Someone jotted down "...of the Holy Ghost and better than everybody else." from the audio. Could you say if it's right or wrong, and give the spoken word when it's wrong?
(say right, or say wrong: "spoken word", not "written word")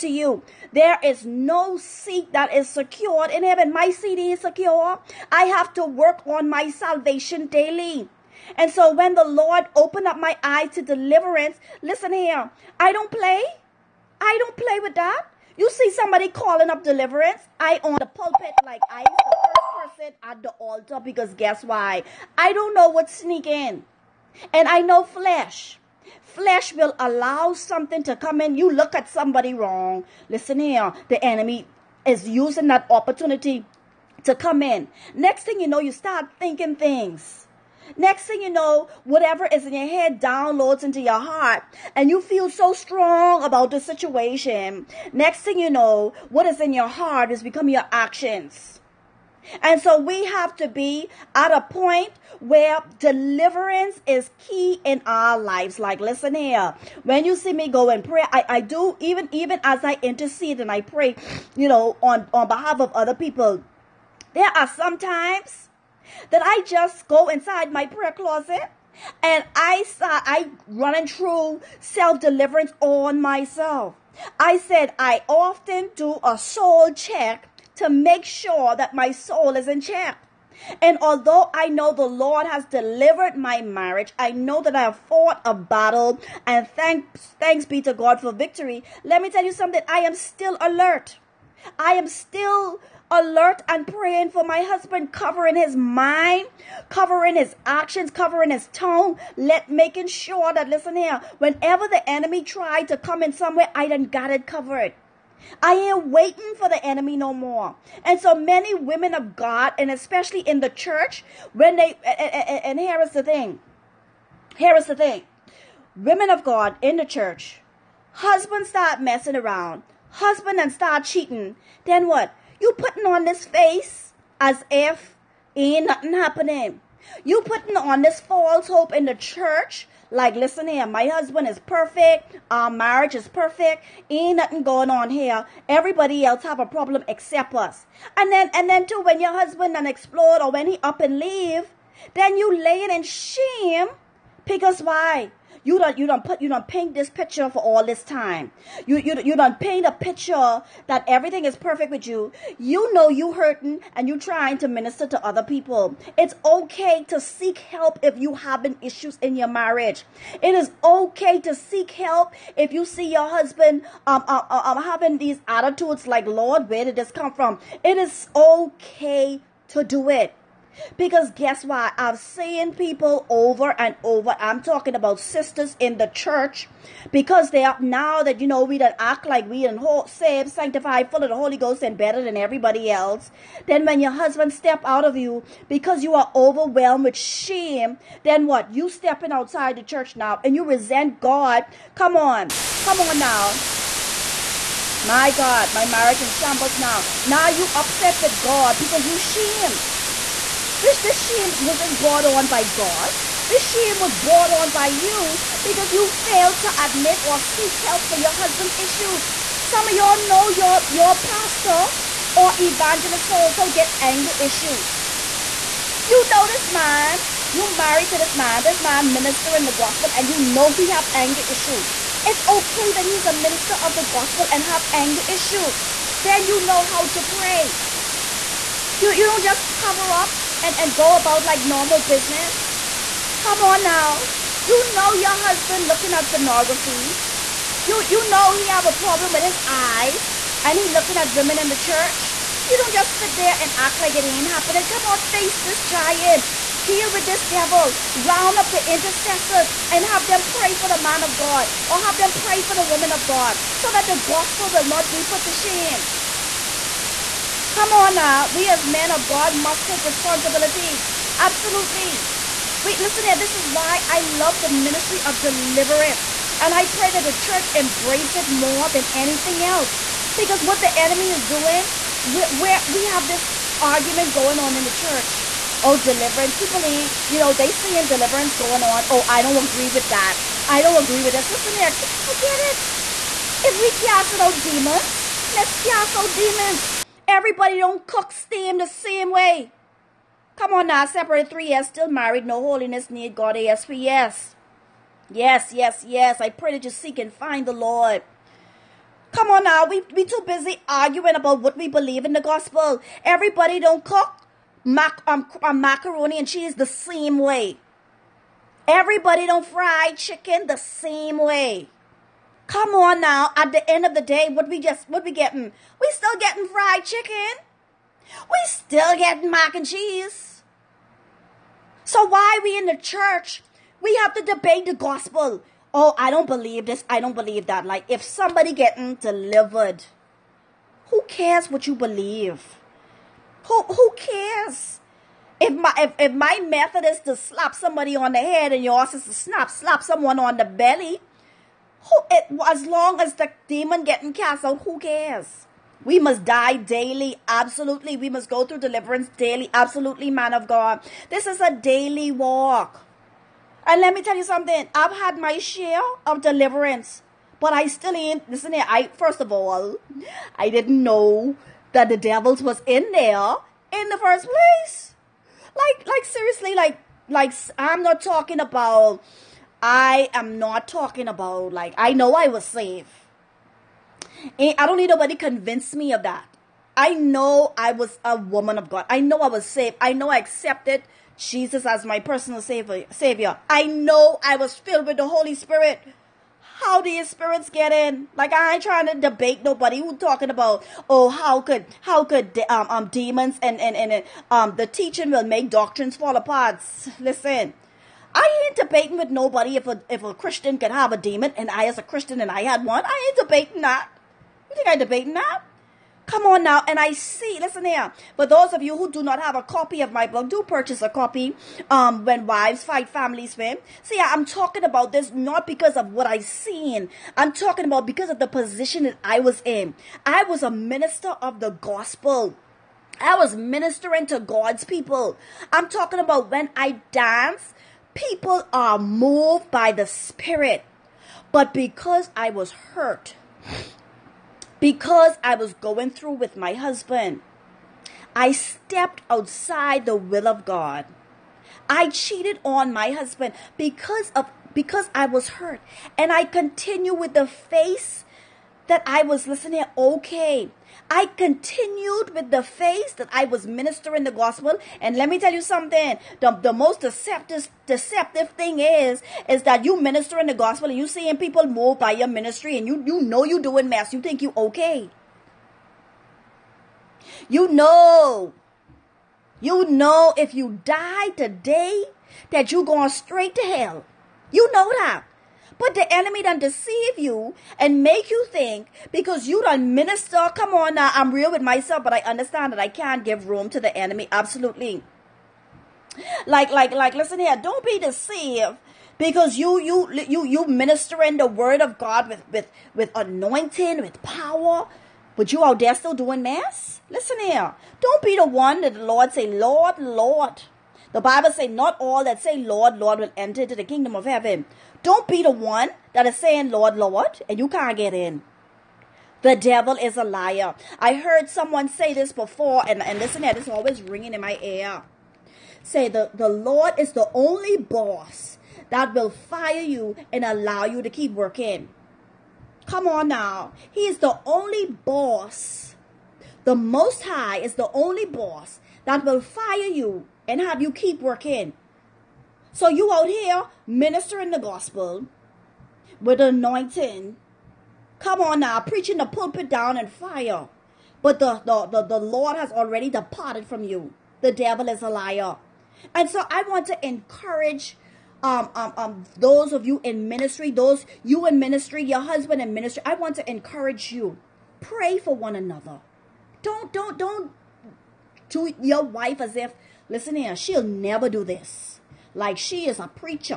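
right.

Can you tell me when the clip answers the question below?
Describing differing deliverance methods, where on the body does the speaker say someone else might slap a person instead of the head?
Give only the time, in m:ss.
5:40.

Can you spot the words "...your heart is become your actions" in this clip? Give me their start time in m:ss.
0:46.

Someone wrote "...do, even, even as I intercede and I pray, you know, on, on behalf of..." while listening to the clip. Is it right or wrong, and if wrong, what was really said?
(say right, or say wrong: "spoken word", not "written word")
right.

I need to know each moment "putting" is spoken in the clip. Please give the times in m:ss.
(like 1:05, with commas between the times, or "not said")
2:02, 2:07.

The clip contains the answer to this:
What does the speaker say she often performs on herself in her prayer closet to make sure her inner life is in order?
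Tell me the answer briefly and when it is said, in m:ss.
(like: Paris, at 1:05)
soul check, at 1:16.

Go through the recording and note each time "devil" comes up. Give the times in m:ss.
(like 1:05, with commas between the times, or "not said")
4:07, 6:02, 8:29, 9:04.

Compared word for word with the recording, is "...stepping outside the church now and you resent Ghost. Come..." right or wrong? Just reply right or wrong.
wrong.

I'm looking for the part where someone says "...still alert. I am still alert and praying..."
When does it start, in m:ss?
1:30.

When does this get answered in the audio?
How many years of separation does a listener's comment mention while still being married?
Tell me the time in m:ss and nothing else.
4:51.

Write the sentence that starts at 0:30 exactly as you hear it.
Listen here, the enemy is using that opportunity to come in.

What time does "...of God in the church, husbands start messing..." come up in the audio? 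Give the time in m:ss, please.
1:56.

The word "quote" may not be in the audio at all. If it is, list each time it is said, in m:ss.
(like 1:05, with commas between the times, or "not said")
not said.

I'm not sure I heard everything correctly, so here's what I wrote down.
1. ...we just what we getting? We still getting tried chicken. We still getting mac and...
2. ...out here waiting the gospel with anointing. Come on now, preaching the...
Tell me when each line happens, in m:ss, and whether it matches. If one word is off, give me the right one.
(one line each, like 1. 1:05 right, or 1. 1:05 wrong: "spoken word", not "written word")
1. 5:14 wrong: "fried", not "tried"
2. 8:53 wrong: "ministering", not "waiting".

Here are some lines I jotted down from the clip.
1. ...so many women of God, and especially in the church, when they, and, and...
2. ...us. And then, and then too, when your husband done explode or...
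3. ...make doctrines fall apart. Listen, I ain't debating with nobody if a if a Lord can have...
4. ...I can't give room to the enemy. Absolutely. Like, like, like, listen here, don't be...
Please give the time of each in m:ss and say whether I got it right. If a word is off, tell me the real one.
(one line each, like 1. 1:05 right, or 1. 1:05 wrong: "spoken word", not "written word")
1. 1:48 right
2. 2:17 right
3. 6:35 wrong: "Christian", not "Lord"
4. 8:02 right.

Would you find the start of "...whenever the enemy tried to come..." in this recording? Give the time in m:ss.
1:41.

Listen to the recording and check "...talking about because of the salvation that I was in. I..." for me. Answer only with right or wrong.
wrong.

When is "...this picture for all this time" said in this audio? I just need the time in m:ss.
2:26.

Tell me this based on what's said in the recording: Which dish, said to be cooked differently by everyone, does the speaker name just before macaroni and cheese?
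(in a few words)
steam.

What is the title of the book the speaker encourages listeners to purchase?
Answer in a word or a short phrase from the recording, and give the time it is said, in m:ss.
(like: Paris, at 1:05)
When Wives Fight, Families Win, at 6:52.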